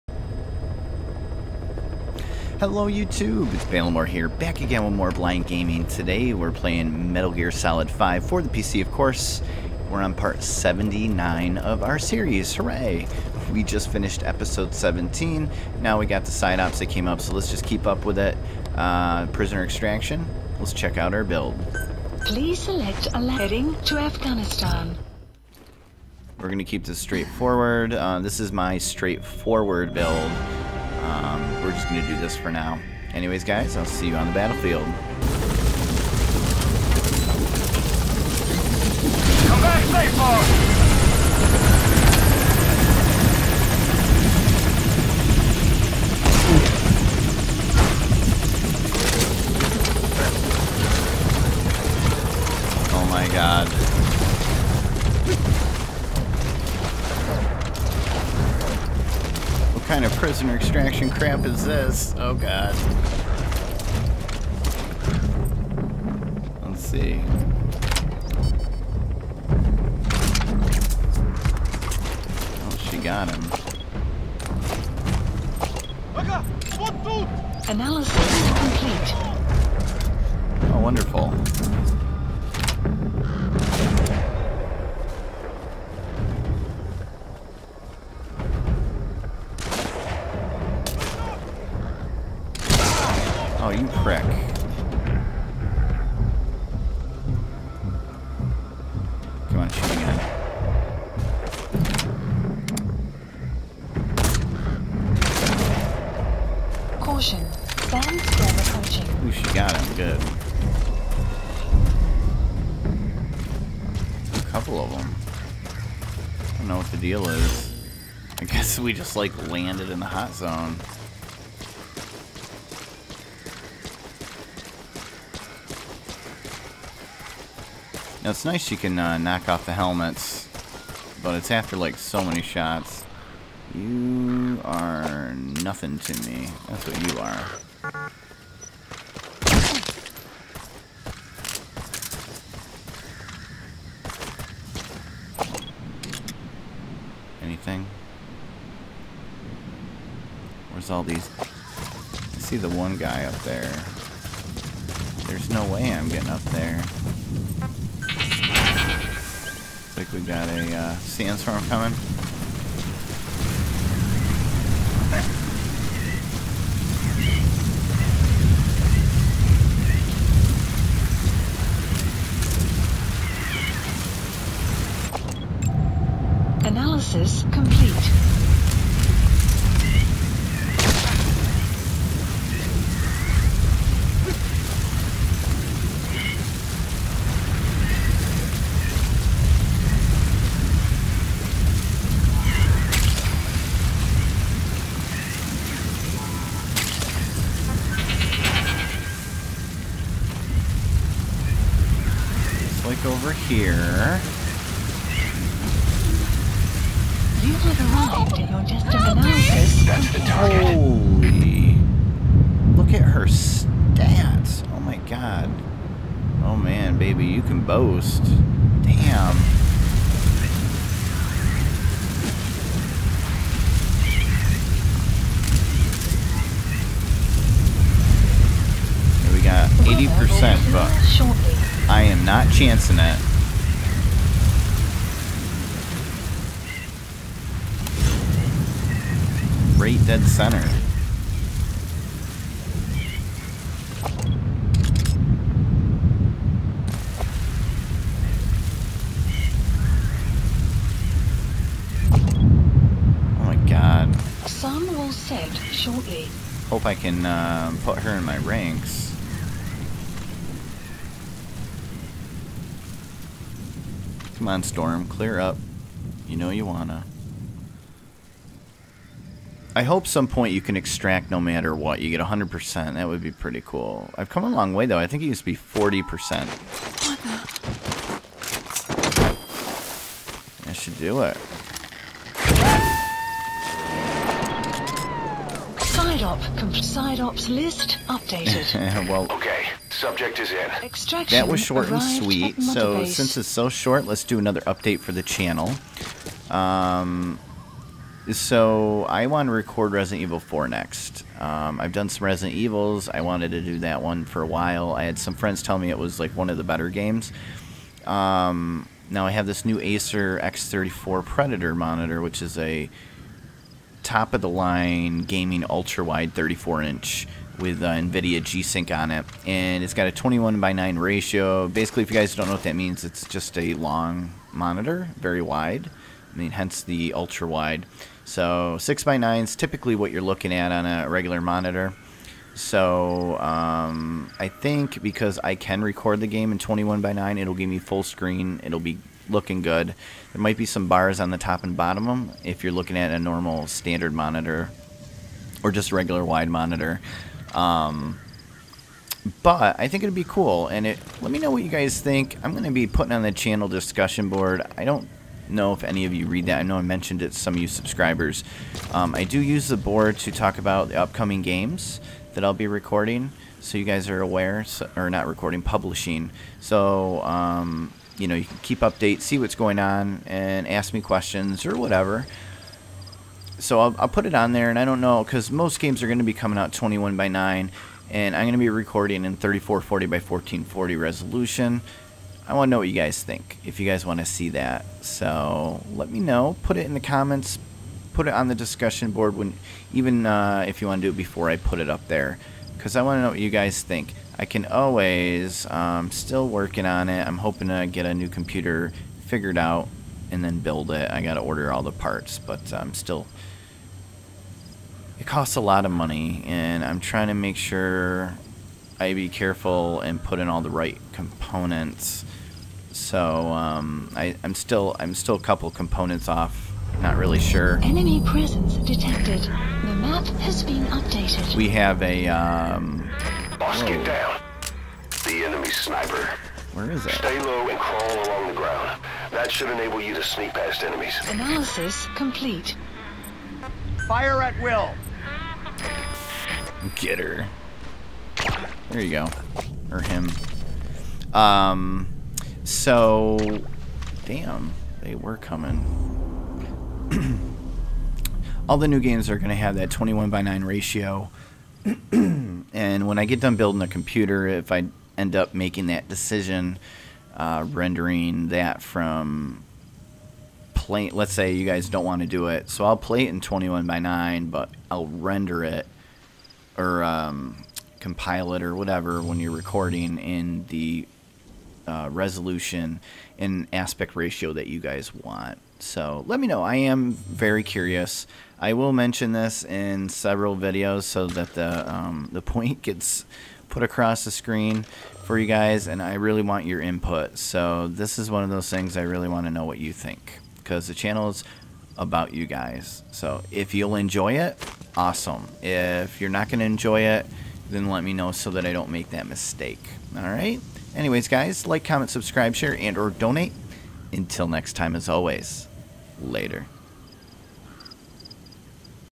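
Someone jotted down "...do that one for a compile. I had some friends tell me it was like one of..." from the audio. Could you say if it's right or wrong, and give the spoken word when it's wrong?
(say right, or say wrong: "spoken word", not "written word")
wrong: "while", not "compile".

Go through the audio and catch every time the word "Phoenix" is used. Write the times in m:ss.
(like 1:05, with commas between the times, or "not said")
not said.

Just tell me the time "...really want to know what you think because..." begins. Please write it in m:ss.
8:09.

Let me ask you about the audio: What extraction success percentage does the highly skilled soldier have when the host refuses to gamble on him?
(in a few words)
80%.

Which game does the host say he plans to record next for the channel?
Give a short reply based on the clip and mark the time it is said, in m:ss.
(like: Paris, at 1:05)
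Resident Evil 4, at 4:59.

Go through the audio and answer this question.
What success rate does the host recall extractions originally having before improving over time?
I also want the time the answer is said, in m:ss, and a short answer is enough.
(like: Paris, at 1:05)
40%, at 4:35.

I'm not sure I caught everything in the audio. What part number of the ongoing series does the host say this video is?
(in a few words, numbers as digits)
79.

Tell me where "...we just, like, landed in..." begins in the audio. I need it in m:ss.
1:58.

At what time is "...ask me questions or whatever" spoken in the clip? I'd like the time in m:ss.
6:10.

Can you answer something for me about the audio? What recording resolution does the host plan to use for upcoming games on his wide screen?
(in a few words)
3440 by 1440.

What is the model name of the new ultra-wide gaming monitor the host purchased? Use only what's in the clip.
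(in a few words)
Acer X34 Predator.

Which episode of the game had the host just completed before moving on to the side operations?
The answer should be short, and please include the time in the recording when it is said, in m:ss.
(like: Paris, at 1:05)
17, at 0:14.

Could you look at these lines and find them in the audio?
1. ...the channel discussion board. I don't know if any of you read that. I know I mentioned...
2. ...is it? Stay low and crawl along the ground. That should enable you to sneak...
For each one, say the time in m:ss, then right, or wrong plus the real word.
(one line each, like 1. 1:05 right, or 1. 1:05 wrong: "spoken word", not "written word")
1. 5:53 right
2. 7:06 right.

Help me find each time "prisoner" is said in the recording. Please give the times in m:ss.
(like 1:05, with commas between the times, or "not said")
0:19, 1:00.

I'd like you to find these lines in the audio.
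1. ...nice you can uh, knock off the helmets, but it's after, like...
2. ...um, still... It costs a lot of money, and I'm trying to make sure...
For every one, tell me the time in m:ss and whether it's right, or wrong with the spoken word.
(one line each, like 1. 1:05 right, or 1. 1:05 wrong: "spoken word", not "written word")
1. 2:08 right
2. 6:42 right.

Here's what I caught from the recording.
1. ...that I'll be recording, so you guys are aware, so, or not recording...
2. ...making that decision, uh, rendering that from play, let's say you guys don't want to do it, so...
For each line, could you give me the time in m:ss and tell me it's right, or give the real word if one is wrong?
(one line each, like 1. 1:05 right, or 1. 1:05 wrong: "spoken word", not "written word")
1. 6:02 right
2. 7:35 right.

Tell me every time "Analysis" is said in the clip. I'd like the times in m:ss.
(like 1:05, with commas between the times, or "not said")
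1:17, 2:56, 7:11.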